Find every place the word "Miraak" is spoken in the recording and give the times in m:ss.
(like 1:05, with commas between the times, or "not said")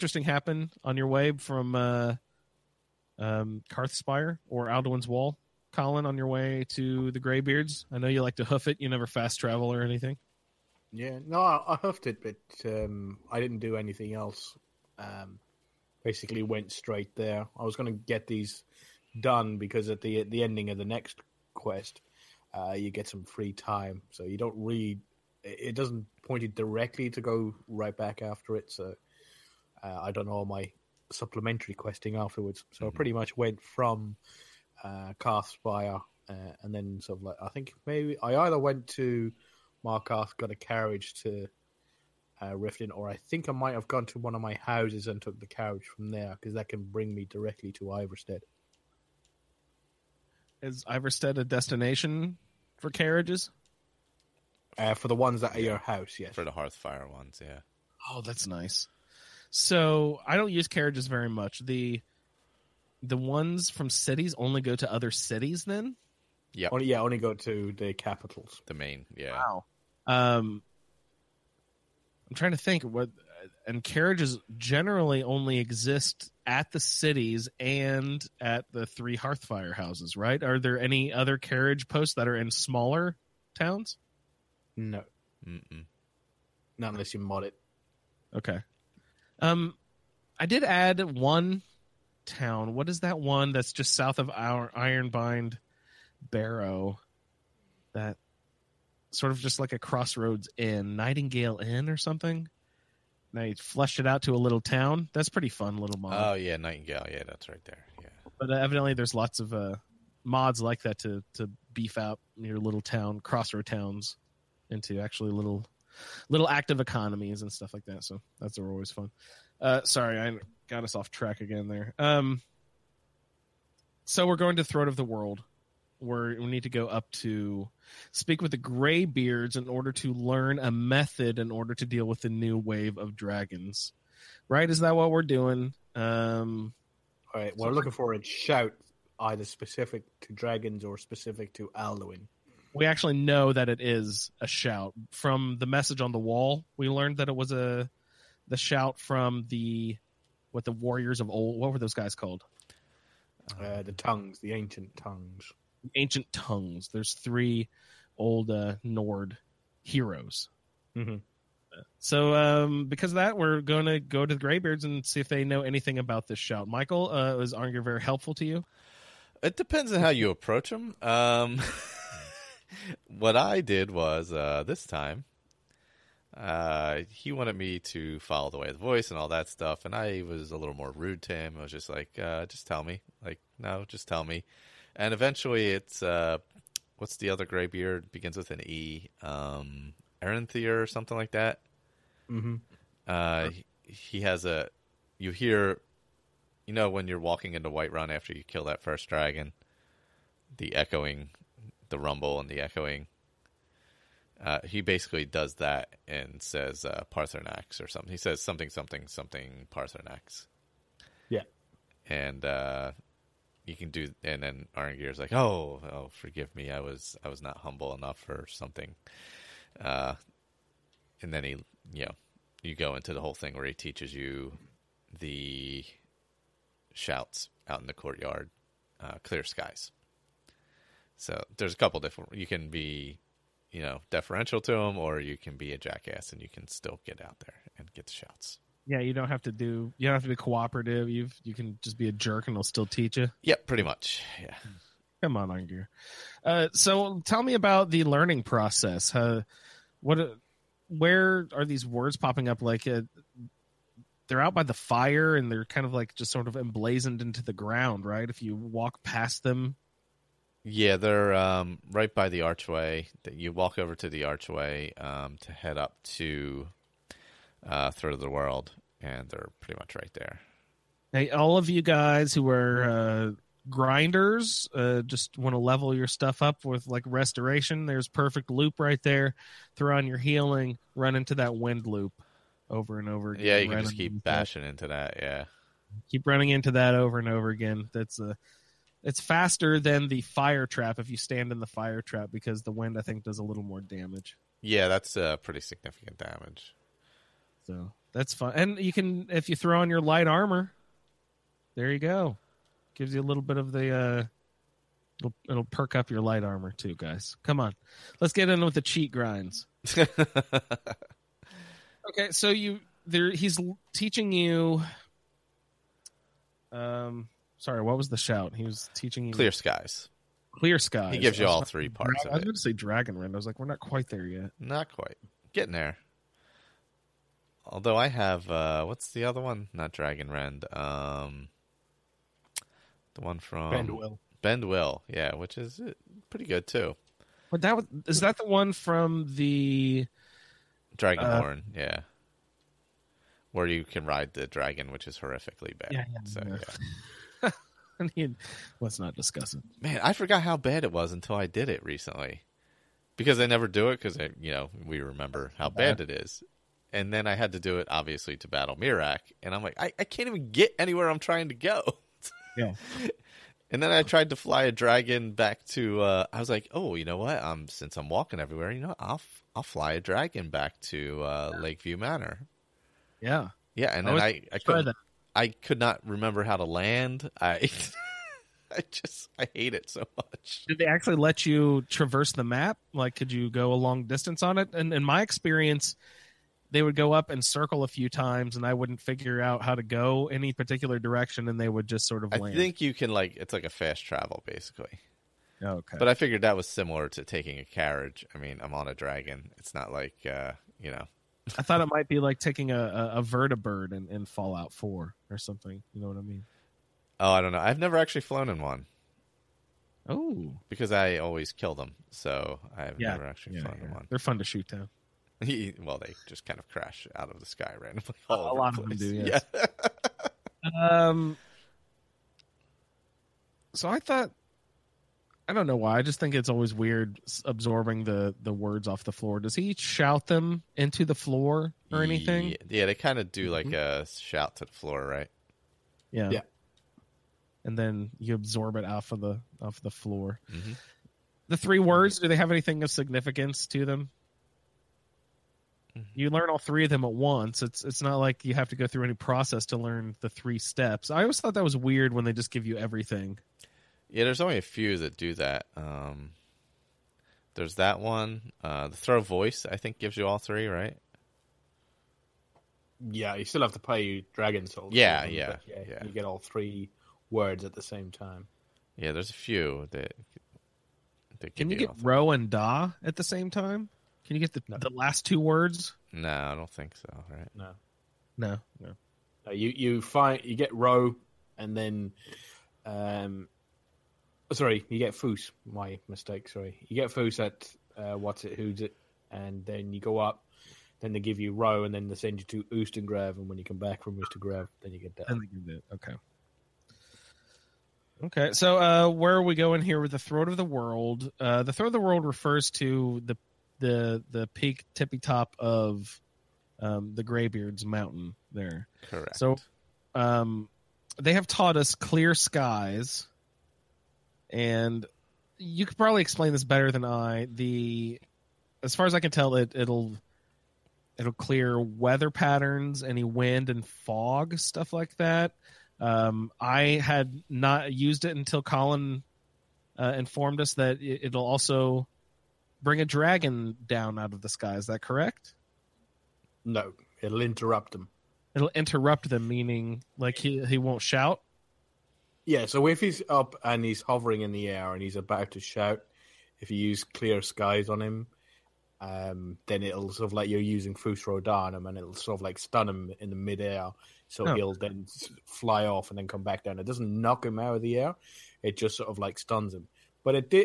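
5:58.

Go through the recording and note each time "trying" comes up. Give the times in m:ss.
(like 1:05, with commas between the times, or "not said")
1:12, 6:01.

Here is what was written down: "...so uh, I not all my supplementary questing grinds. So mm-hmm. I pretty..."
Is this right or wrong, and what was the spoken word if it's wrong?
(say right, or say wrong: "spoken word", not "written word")
wrong: "afterwards", not "grinds".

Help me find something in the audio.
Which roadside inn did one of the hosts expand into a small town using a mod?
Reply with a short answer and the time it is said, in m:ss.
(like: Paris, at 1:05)
Nightingale Inn, at 1:40.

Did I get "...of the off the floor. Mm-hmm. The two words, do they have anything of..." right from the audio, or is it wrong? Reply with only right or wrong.
wrong.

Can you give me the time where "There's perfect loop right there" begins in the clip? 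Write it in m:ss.
4:37.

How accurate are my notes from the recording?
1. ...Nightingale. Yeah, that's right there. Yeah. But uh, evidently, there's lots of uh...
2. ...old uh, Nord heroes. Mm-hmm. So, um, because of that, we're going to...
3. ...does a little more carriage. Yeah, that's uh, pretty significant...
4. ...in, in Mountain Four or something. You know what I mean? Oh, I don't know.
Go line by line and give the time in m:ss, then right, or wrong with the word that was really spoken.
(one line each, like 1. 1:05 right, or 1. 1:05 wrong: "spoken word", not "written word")
1. 1:46 right
2. 2:38 right
3. 4:53 wrong: "damage", not "carriage"
4. 6:43 wrong: "Fallout", not "Mountain".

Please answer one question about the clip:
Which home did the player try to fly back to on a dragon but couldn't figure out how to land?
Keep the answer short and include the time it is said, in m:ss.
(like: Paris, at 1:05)
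Lakeview Manor, at 6:11.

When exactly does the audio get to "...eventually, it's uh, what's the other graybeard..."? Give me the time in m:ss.
3:05.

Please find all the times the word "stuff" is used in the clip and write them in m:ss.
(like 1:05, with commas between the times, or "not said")
1:57, 2:59, 4:36, 8:44.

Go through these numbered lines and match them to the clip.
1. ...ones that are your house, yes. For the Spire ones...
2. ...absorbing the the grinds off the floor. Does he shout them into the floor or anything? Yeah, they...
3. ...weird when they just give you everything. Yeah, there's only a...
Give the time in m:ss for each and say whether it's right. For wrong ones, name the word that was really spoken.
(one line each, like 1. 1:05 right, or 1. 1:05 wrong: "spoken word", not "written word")
1. 0:55 wrong: "Hearthfire", not "Spire"
2. 7:07 wrong: "words", not "grinds"
3. 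7:31 right.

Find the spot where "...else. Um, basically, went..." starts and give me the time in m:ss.
0:14.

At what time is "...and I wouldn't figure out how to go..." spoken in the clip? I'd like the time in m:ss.
6:28.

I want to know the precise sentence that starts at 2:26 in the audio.
We learned that it was a the shout from the what the warriors of old.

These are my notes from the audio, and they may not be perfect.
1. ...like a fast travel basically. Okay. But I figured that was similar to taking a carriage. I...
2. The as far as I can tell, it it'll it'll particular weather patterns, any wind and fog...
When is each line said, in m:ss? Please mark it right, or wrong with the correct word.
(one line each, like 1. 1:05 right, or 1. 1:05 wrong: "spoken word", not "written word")
1. 6:33 right
2. 8:37 wrong: "clear", not "particular".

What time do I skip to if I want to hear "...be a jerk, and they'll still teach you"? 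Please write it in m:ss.
4:01.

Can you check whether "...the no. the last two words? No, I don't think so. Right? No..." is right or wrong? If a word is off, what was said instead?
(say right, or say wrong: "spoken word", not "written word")
right.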